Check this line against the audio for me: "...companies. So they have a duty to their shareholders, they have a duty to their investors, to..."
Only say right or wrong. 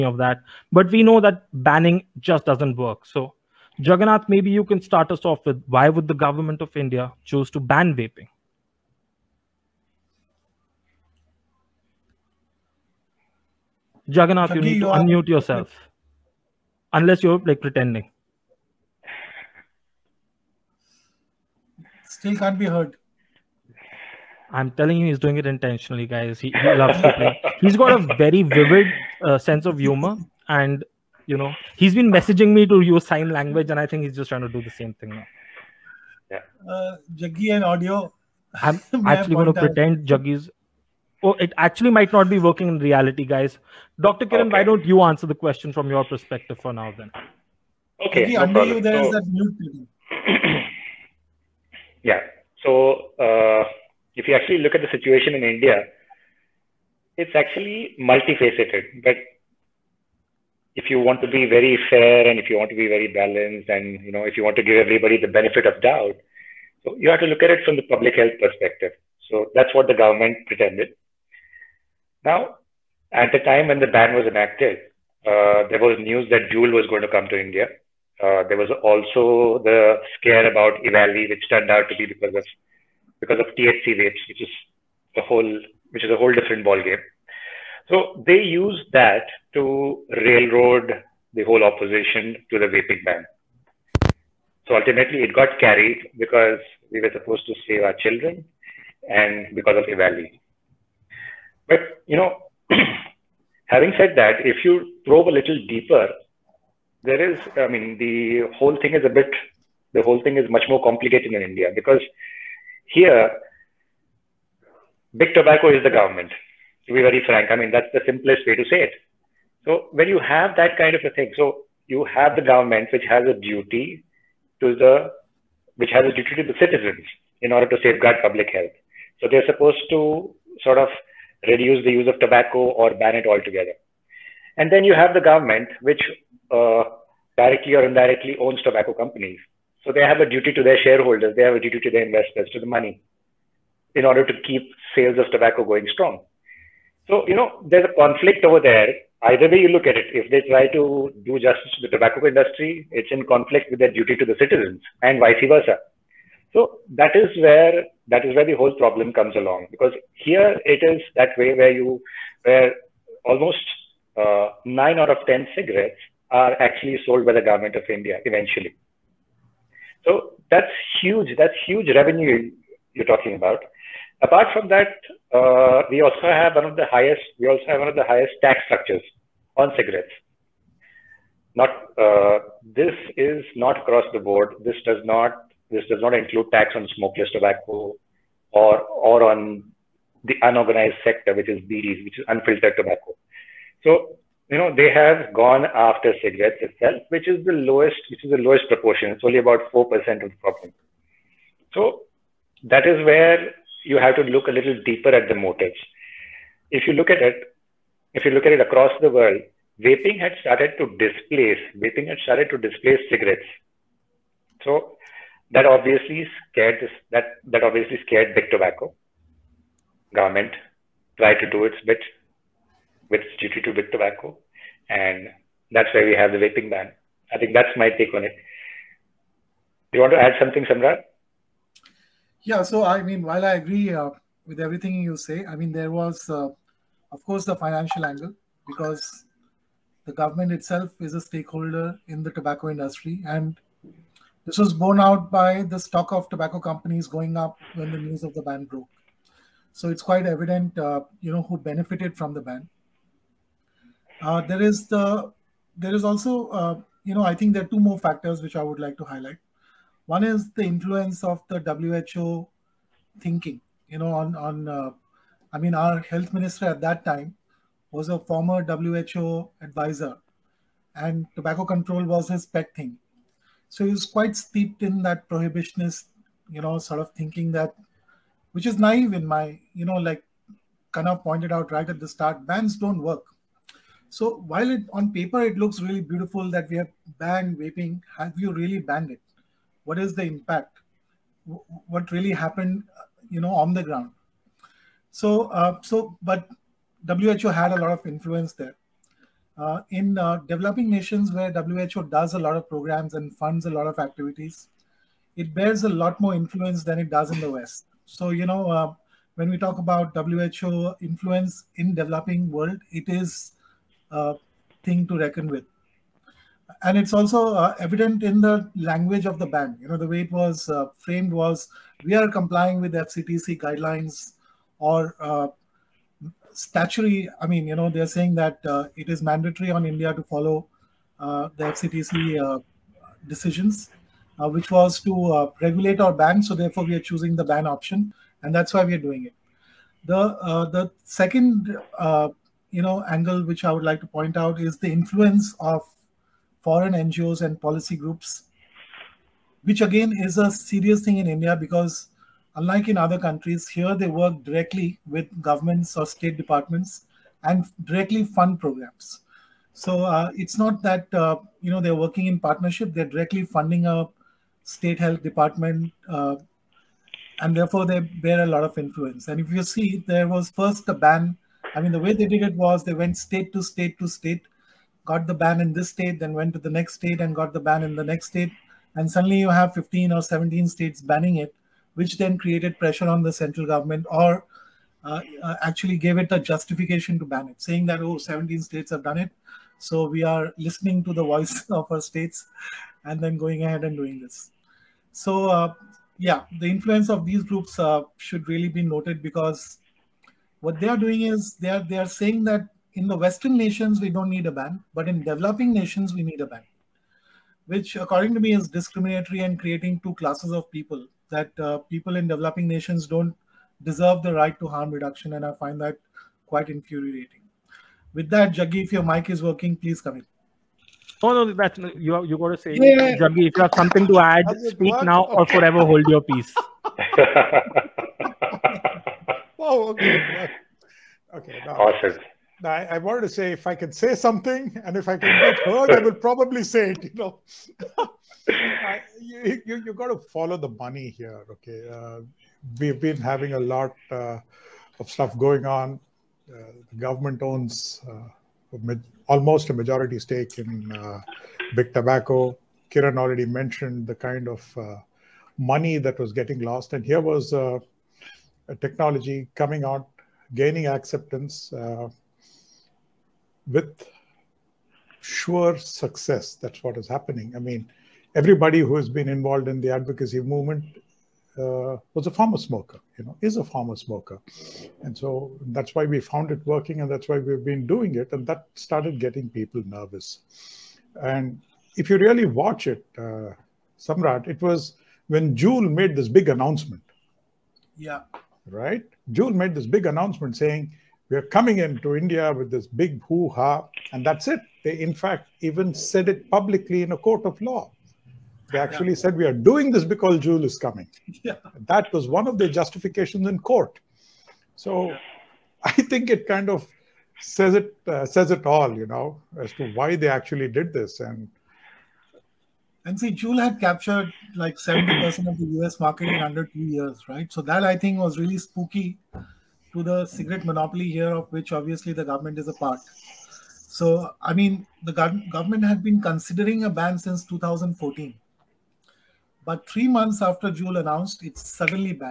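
right.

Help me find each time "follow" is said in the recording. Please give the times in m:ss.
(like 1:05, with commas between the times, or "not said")
5:30, 7:20.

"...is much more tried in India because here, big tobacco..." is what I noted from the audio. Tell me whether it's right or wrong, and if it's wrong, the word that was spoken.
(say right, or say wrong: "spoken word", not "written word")
wrong: "complicated", not "tried".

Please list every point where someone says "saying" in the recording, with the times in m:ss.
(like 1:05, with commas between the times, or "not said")
5:28, 6:27, 6:42, 8:10.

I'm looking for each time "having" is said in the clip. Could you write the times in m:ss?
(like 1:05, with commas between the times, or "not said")
1:43, 7:23.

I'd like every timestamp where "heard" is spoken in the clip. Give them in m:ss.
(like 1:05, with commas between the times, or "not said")
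0:22, 7:15.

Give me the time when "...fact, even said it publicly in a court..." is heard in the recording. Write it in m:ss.
8:15.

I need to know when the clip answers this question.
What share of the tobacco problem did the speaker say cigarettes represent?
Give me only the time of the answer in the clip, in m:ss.
3:19.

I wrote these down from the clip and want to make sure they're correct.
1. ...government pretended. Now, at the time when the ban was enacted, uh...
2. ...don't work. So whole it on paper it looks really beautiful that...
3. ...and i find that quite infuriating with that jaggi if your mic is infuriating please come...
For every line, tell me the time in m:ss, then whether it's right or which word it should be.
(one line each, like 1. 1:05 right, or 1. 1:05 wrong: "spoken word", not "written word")
1. 1:09 right
2. 4:42 wrong: "while", not "whole"
3. 6:55 wrong: "working", not "infuriating".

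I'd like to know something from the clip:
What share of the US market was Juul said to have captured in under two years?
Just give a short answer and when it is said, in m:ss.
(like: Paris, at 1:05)
70%, at 8:34.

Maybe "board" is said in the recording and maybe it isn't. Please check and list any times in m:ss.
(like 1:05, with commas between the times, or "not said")
3:04.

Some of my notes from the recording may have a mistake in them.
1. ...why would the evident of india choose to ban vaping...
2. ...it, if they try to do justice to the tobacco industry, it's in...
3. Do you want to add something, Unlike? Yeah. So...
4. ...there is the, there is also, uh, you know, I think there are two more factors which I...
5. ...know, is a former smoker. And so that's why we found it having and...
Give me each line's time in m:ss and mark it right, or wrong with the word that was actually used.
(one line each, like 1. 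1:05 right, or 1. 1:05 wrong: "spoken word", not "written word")
1. 0:05 wrong: "government", not "evident"
2. 2:29 right
3. 3:49 wrong: "Samrat", not "Unlike"
4. 4:14 right
5. 7:53 wrong: "working", not "having".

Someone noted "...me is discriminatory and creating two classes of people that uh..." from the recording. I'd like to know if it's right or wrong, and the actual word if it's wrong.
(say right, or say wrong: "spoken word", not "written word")
right.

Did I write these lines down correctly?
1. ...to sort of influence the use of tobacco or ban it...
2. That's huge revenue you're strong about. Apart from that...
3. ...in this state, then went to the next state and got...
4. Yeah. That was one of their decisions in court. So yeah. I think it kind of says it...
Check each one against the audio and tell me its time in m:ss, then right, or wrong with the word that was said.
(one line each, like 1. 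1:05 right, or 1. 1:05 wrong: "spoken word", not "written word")
1. 2:09 wrong: "reduce", not "influence"
2. 2:51 wrong: "talking", not "strong"
3. 6:15 right
4. 8:21 wrong: "justifications", not "decisions".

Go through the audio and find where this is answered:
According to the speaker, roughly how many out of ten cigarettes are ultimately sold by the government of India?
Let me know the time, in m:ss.
2:44.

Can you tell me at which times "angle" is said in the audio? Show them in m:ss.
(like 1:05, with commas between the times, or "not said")
3:58, 5:43.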